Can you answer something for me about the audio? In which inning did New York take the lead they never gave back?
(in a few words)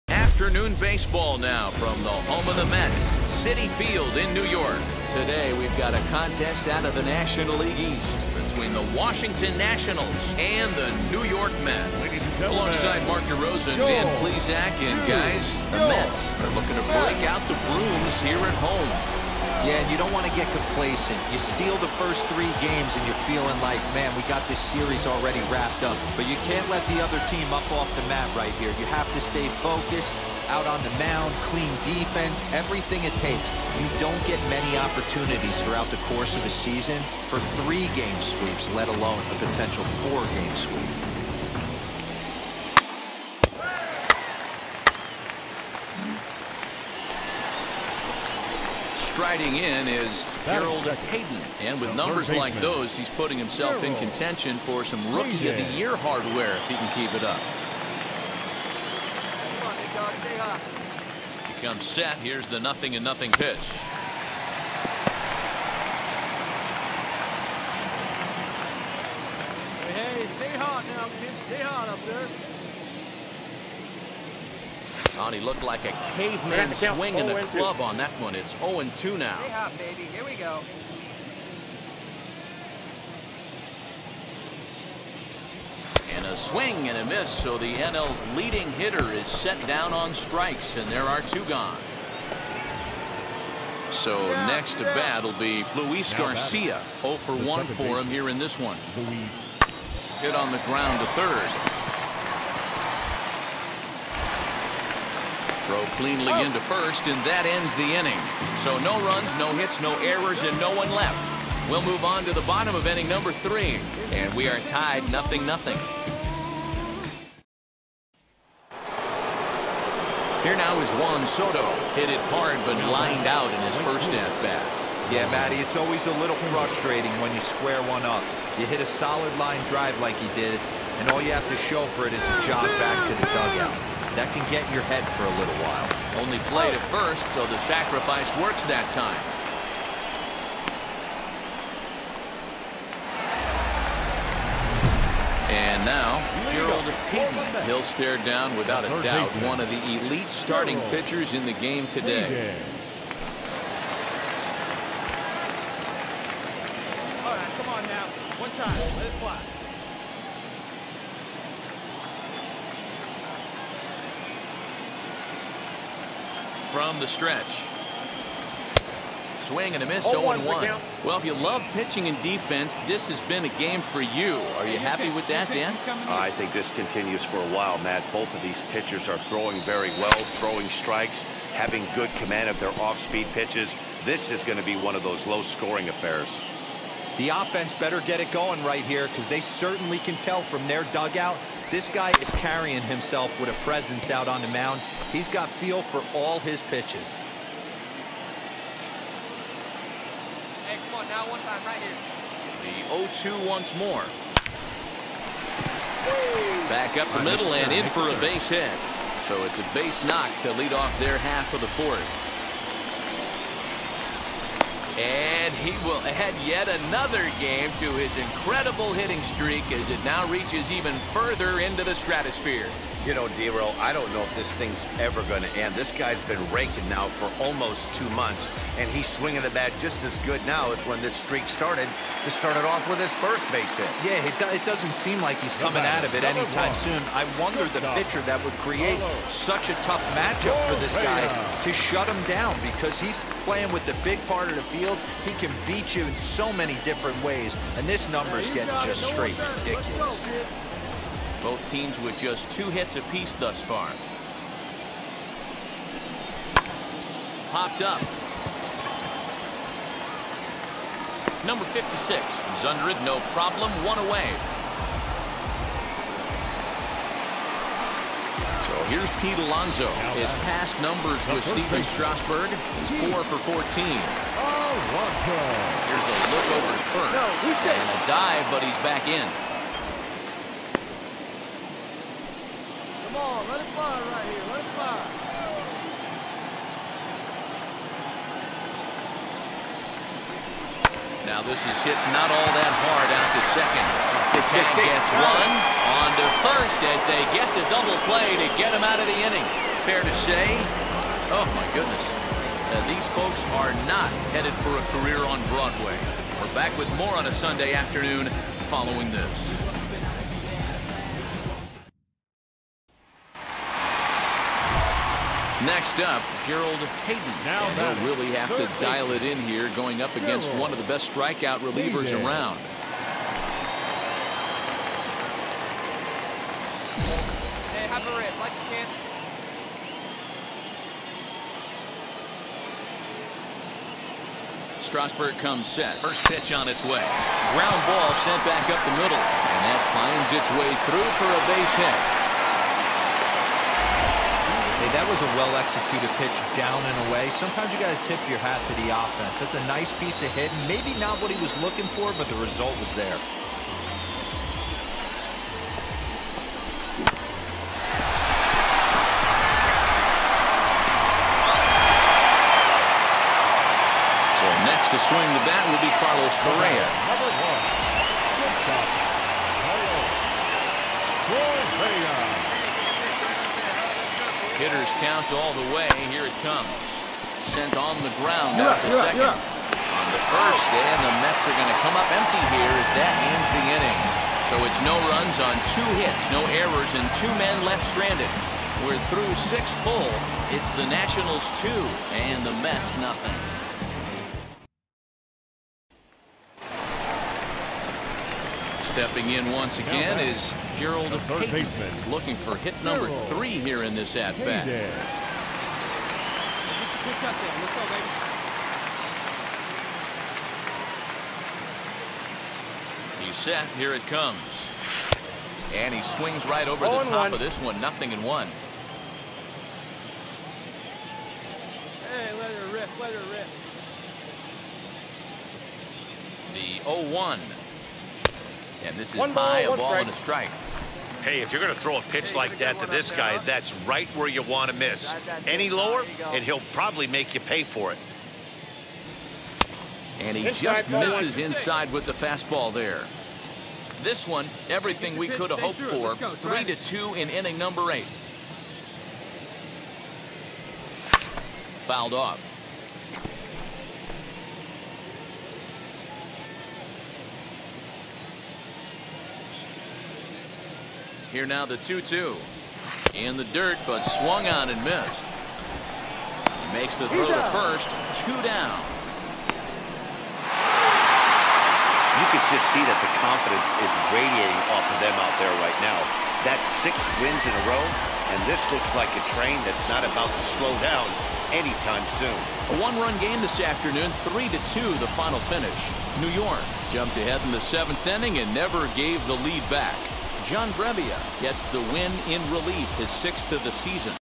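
Seventh.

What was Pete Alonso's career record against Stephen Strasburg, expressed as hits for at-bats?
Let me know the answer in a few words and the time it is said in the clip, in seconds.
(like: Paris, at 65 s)
4 for 14, at 273 s.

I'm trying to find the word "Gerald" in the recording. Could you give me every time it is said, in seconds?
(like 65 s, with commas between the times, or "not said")
50 s, 146 s, 316 s, 400 s.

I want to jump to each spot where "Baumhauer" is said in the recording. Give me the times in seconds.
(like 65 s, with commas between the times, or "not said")
not said.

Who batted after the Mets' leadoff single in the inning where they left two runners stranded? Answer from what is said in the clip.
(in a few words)
Carlos Correa.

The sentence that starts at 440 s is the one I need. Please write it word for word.
And he just misses inside with the fastball there.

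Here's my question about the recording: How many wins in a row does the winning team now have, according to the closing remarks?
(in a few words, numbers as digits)
6.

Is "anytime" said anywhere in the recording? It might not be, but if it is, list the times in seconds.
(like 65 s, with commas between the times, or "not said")
236 s, 481 s.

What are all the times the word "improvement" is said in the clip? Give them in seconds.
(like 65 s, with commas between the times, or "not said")
not said.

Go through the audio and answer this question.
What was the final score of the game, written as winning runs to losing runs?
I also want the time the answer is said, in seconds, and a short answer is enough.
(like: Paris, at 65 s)
3 to 2, at 484 s.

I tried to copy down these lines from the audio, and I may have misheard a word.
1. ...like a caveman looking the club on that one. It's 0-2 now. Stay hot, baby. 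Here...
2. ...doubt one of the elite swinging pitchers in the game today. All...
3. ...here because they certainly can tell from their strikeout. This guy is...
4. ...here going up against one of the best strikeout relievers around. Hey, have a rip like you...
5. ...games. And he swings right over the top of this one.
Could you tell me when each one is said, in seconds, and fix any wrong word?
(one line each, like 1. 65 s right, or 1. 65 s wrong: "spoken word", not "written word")
1. 75 s wrong: "swinging", not "looking"
2. 149 s wrong: "starting", not "swinging"
3. 188 s wrong: "dugout", not "strikeout"
4. 319 s right
5. 414 s wrong: "comes", not "games".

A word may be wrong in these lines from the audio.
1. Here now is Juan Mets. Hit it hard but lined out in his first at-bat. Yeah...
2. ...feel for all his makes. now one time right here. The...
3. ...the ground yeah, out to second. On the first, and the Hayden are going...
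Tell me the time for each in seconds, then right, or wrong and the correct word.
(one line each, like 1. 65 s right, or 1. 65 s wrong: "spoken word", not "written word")
1. 120 s wrong: "Soto", not "Mets"
2. 195 s wrong: "pitches", not "makes"
3. 378 s wrong: "Mets", not "Hayden".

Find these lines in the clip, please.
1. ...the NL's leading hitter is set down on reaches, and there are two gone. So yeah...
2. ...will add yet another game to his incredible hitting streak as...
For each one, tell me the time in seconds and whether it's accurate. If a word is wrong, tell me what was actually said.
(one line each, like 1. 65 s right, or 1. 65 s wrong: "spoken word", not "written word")
1. 87 s wrong: "strikes", not "reaches"
2. 215 s right.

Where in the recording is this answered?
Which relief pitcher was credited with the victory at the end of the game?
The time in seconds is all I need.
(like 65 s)
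490 s.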